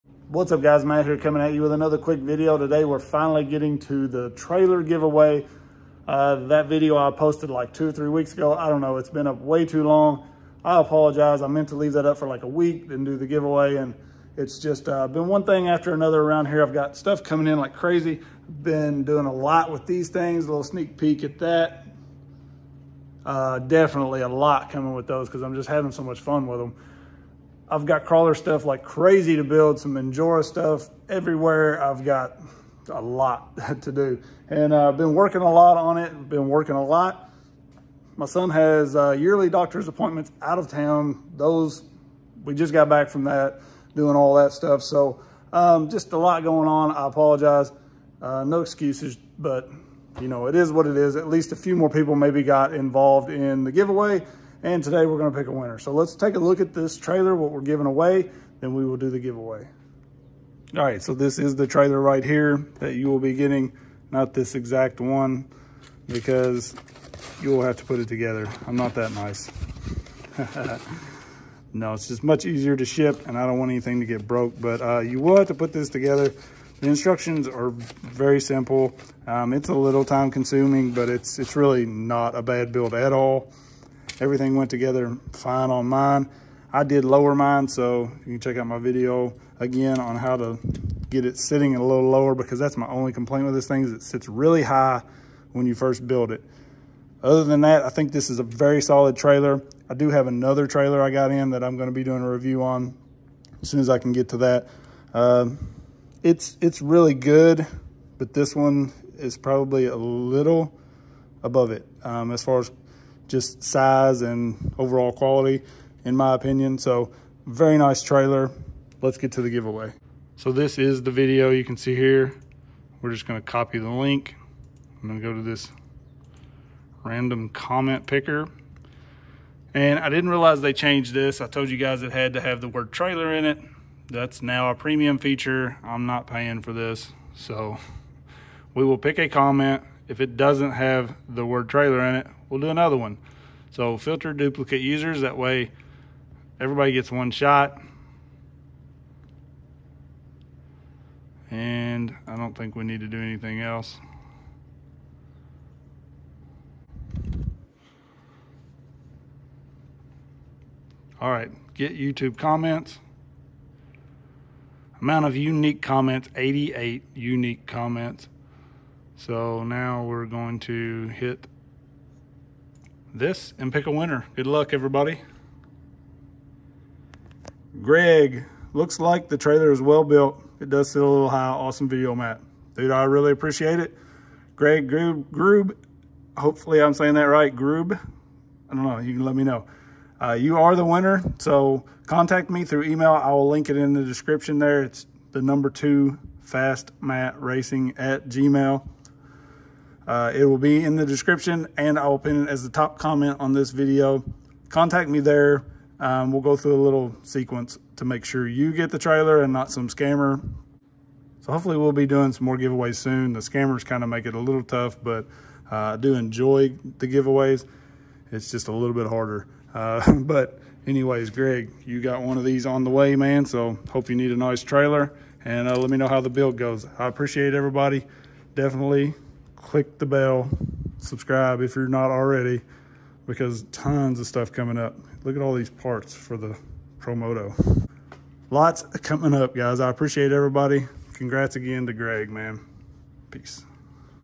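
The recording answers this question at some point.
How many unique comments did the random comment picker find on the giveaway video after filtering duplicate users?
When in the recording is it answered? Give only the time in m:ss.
2:46.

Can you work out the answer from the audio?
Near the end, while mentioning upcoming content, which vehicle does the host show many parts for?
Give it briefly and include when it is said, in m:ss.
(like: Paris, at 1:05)
Promoto, at 3:56.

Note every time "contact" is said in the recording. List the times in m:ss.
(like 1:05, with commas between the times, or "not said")
3:12, 3:24.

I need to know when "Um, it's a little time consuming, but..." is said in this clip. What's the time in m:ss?
1:19.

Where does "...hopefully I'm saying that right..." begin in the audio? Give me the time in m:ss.
3:06.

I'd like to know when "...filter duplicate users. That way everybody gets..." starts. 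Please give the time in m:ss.
2:23.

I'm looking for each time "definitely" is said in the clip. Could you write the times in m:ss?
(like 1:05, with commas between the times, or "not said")
0:23, 3:48.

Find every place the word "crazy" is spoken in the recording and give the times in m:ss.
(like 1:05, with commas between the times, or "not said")
0:17, 0:28.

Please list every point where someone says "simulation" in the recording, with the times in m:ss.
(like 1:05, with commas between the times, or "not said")
not said.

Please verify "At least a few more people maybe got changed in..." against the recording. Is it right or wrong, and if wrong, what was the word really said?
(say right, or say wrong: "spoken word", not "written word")
wrong: "involved", not "changed".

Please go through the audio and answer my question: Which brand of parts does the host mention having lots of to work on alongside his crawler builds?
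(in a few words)
Injora.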